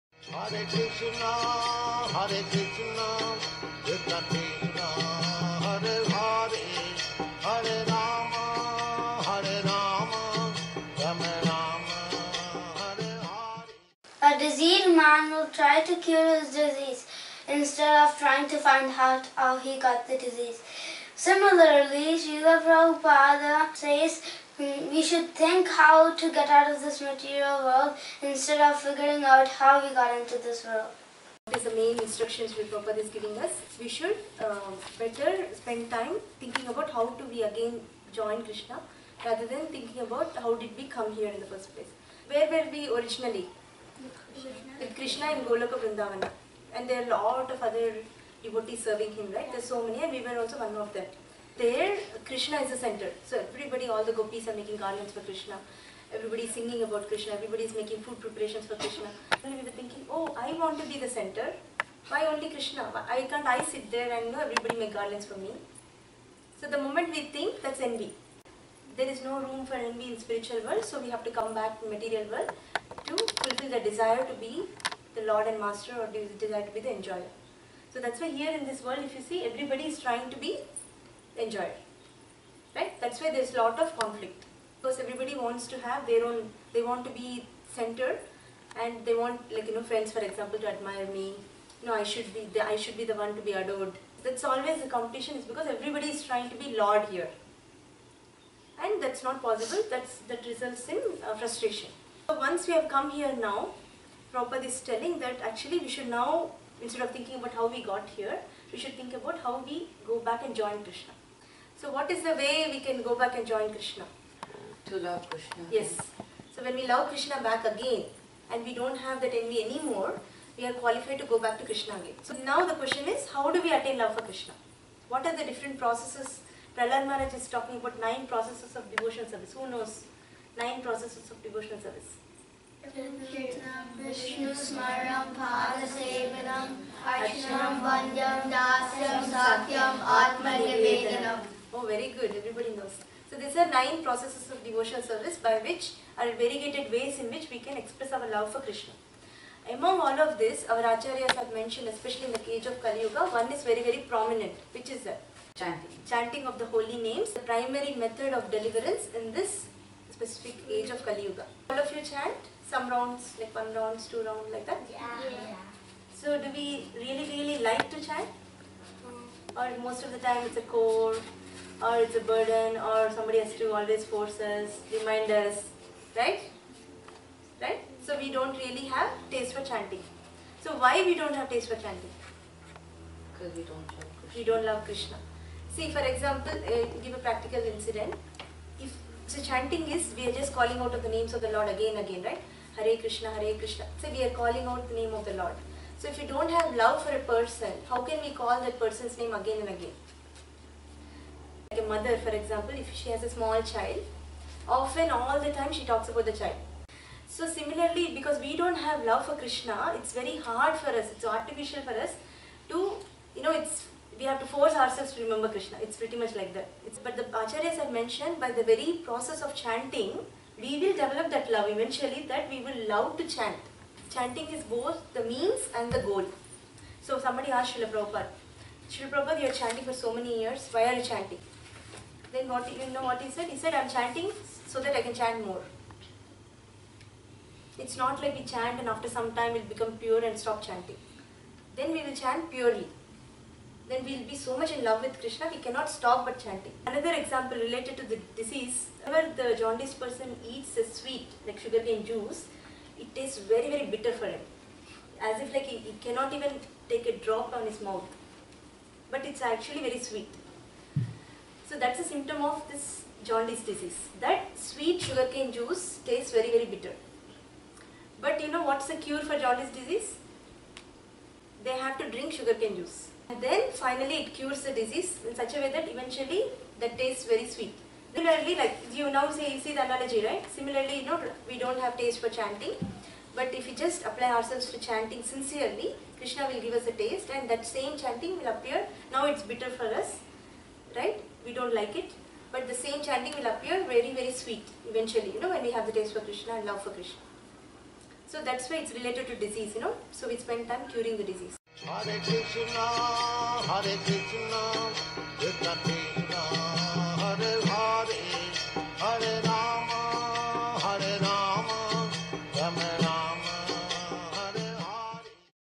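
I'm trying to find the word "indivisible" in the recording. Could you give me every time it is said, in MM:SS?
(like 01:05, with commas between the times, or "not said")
not said.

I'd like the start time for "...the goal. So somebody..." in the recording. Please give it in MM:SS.
03:45.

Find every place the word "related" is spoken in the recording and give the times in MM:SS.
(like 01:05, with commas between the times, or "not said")
04:07, 04:58.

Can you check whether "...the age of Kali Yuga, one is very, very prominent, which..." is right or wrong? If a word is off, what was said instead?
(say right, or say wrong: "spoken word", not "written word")
right.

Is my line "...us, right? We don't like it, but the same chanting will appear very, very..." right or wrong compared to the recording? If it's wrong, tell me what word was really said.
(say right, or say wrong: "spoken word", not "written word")
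right.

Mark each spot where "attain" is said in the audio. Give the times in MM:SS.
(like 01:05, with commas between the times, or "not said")
02:03.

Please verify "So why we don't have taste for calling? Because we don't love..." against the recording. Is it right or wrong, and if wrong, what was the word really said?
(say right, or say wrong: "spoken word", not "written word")
wrong: "chanting", not "calling".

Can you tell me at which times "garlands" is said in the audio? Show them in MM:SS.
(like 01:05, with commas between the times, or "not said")
00:54, 01:04.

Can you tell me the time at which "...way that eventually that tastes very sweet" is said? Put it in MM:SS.
04:35.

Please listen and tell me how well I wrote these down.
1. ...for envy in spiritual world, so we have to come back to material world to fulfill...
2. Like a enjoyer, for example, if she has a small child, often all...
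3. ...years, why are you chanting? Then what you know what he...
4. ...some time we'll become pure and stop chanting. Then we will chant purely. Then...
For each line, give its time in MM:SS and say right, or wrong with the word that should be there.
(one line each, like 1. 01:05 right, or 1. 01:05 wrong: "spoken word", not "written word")
1. 01:09 right
2. 03:21 wrong: "mother", not "enjoyer"
3. 03:50 right
4. 03:59 right.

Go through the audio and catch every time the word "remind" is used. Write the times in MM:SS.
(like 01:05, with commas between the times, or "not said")
02:54.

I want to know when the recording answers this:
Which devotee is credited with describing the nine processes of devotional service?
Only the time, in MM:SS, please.
02:06.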